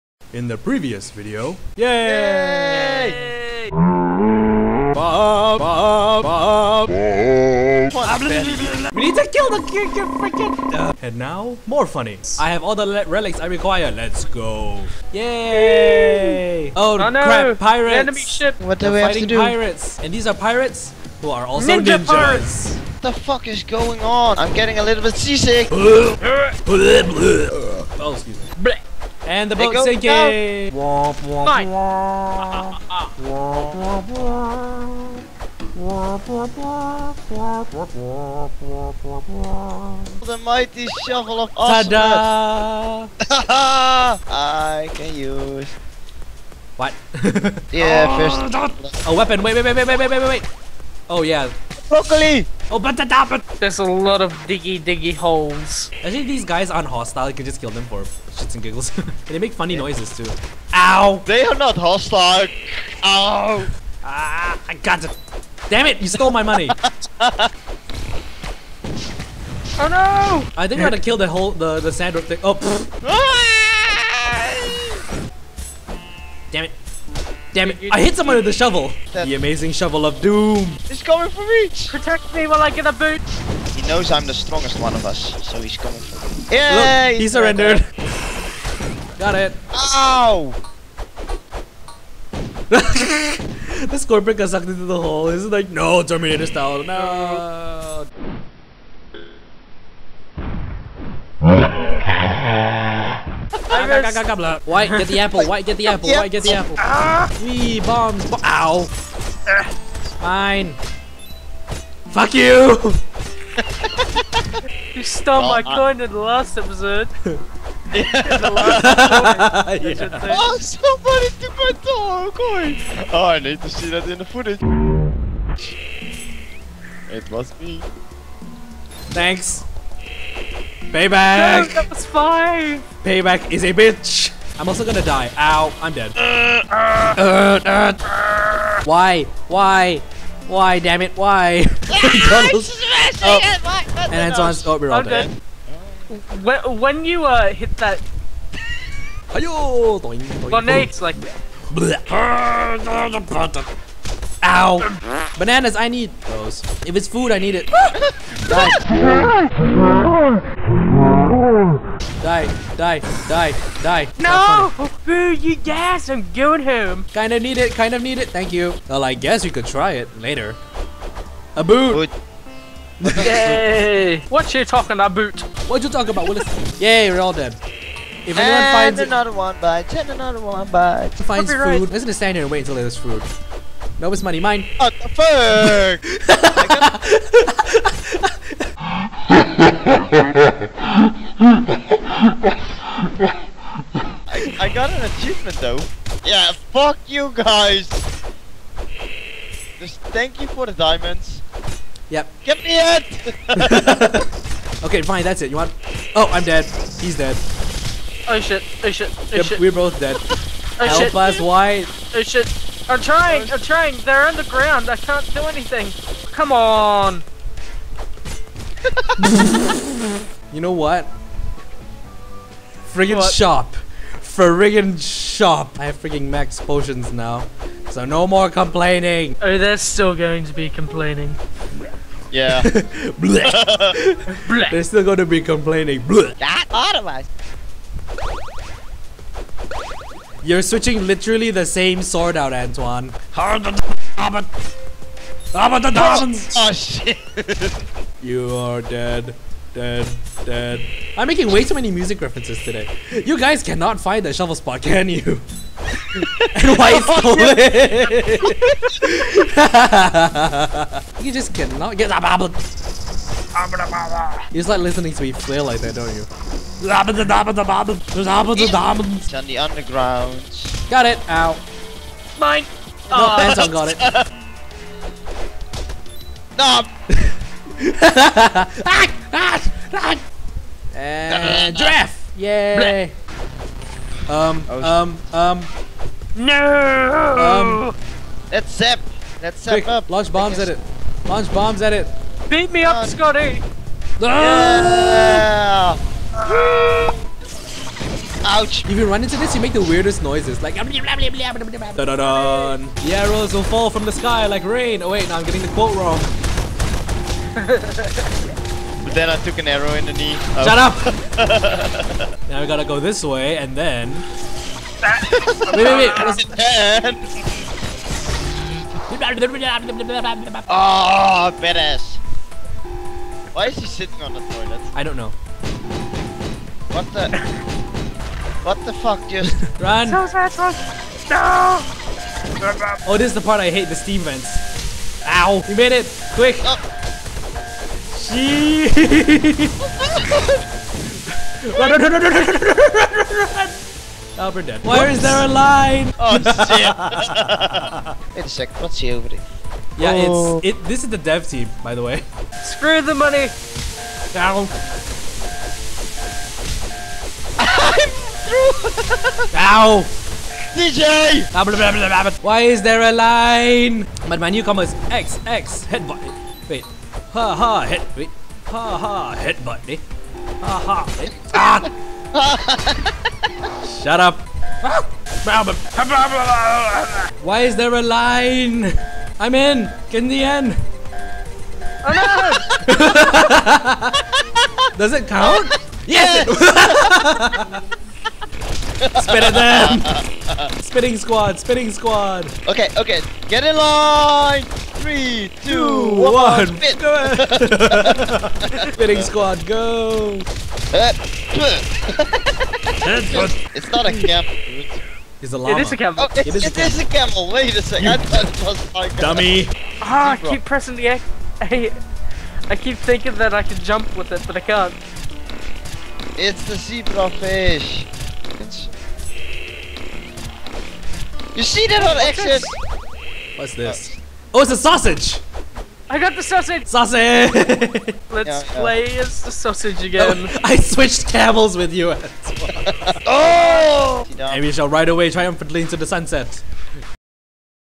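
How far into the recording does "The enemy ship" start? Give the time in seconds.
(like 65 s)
17 s.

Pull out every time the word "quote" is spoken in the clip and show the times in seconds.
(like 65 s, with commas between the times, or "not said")
305 s.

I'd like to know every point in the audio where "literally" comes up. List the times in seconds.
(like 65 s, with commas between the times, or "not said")
241 s.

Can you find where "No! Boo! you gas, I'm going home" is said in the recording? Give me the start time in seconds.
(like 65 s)
164 s.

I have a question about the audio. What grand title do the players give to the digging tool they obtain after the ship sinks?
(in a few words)
Mighty shovel of awesome.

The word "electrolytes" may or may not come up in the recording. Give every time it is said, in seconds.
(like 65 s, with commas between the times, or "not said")
not said.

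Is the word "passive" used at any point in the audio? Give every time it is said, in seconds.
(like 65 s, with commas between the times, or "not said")
not said.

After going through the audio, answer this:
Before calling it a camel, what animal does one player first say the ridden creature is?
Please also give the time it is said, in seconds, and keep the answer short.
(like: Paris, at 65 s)
Llama, at 405 s.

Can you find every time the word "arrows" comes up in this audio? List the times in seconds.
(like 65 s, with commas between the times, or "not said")
303 s, 309 s.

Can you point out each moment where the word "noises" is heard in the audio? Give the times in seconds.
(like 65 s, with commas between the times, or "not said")
59 s, 300 s.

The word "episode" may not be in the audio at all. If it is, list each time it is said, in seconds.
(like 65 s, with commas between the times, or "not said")
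116 s.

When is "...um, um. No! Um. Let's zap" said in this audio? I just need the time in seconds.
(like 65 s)
285 s.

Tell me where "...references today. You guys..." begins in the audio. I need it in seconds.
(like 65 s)
252 s.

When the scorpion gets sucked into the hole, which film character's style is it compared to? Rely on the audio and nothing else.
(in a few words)
Terminator.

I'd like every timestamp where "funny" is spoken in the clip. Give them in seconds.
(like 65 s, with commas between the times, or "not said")
11 s, 59 s.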